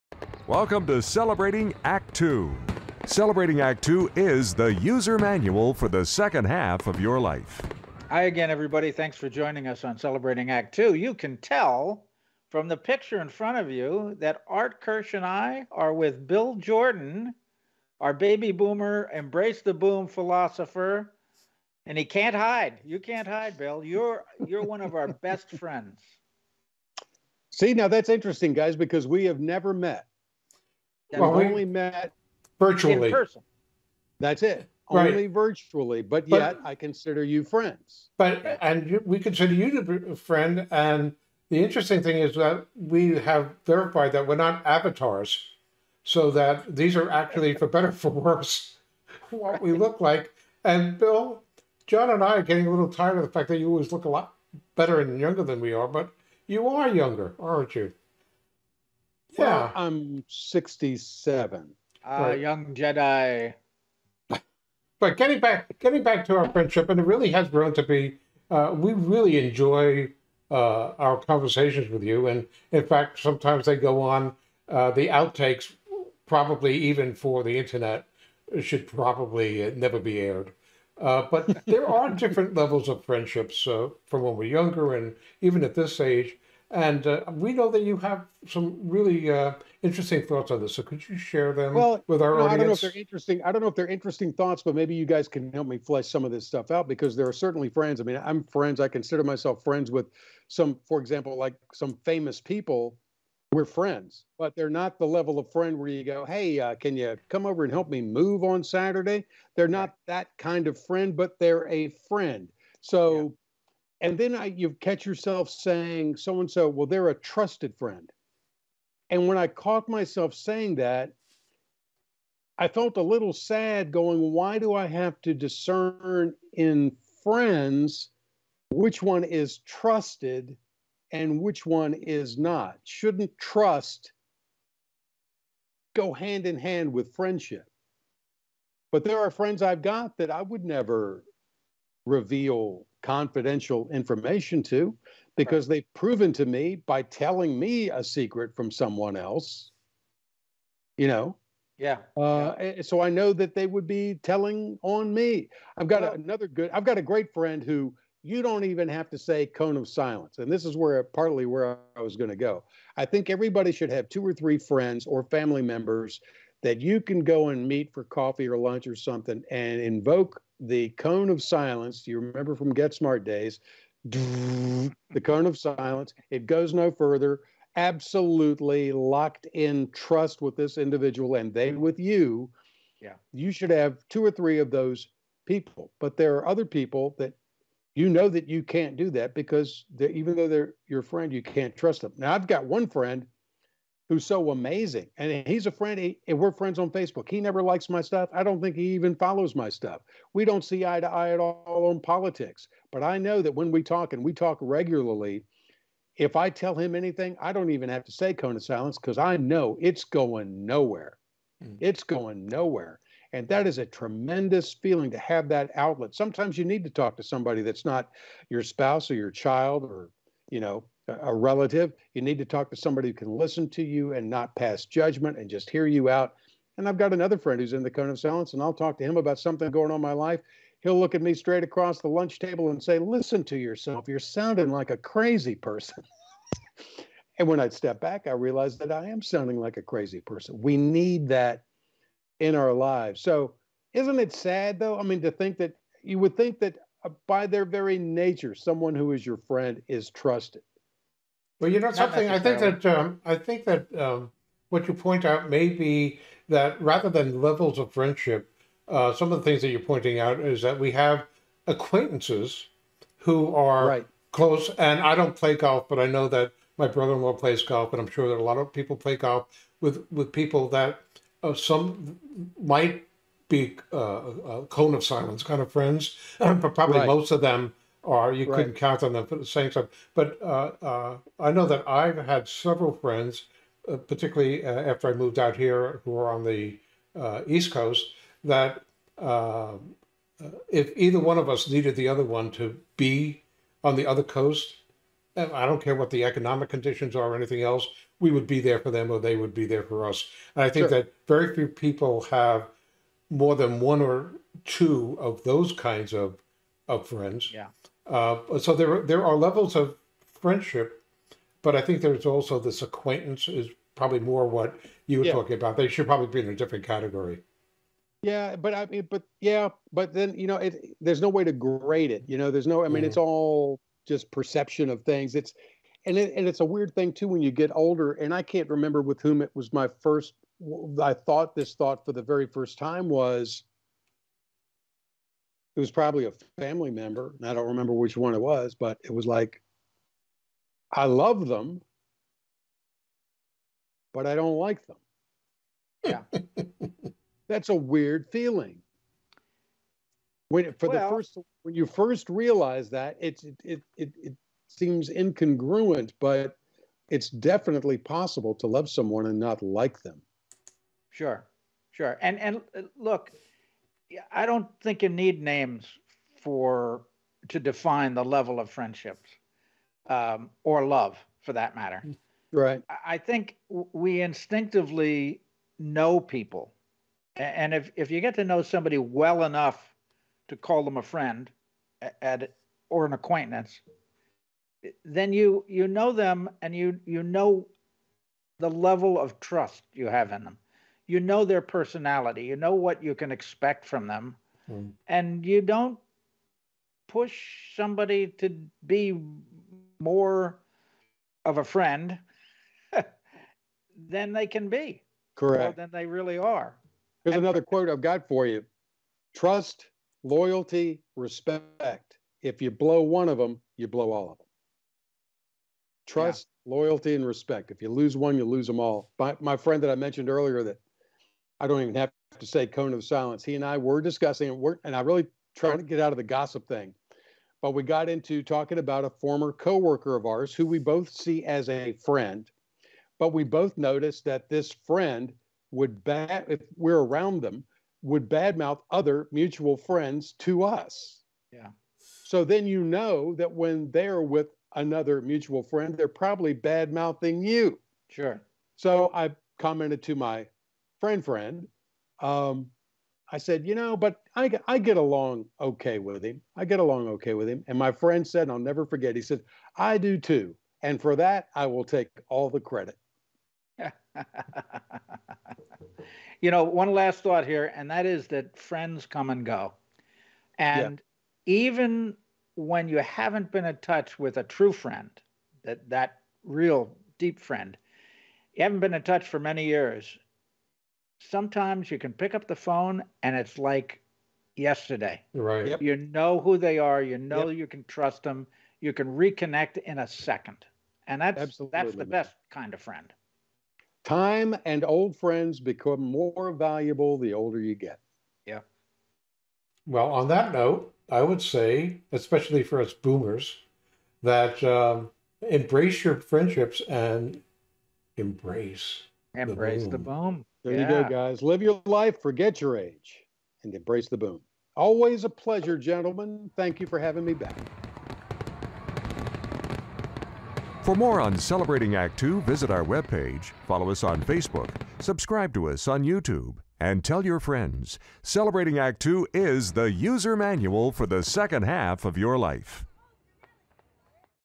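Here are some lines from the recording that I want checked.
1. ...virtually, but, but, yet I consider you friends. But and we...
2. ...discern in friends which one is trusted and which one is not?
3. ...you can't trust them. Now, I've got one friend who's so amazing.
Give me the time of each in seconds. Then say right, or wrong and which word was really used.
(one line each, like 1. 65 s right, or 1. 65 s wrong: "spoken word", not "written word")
1. 35 s right
2. 125 s right
3. 191 s right.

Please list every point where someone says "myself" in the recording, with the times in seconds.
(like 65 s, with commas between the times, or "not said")
99 s, 119 s.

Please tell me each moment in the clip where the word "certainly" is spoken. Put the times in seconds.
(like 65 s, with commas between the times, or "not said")
97 s.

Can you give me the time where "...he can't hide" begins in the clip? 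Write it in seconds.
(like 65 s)
21 s.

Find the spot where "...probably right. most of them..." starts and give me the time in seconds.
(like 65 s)
276 s.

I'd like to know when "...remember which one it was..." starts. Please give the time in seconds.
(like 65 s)
337 s.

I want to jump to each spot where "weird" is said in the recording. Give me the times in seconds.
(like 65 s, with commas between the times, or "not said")
326 s, 347 s.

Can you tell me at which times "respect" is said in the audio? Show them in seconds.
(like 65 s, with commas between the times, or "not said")
411 s, 417 s.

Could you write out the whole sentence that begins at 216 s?
Sometimes you need to talk to somebody that's not your spouse or your child or, you know, a relative.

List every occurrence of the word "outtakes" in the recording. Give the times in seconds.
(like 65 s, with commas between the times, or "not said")
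75 s.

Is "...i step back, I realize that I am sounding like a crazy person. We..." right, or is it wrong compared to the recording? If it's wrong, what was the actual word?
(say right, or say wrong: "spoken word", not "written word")
right.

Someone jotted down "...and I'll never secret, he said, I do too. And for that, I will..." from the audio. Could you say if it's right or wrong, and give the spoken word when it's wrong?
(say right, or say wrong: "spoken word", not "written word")
wrong: "forget", not "secret".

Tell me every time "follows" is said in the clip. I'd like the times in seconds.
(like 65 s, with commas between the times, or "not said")
199 s, 523 s.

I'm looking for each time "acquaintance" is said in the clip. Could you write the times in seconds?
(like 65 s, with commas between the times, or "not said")
261 s, 312 s, 383 s.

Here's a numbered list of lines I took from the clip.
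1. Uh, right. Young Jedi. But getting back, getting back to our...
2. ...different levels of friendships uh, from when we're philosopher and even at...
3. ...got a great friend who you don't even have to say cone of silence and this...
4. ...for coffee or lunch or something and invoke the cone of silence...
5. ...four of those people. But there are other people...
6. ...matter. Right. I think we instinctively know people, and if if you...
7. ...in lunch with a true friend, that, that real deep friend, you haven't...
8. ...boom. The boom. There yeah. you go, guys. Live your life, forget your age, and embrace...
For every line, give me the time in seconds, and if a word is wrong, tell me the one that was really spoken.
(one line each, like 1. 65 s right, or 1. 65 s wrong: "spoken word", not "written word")
1. 62 s right
2. 82 s wrong: "younger", not "philosopher"
3. 156 s right
4. 167 s right
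5. 184 s wrong: "three", not "four"
6. 371 s right
7. 473 s wrong: "touch", not "lunch"
8. 509 s right.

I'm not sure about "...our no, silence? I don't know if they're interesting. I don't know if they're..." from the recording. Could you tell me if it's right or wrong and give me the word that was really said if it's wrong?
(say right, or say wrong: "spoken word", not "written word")
wrong: "audience", not "silence".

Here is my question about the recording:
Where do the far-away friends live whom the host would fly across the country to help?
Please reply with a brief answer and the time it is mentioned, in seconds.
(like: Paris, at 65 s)
East Coast, at 287 s.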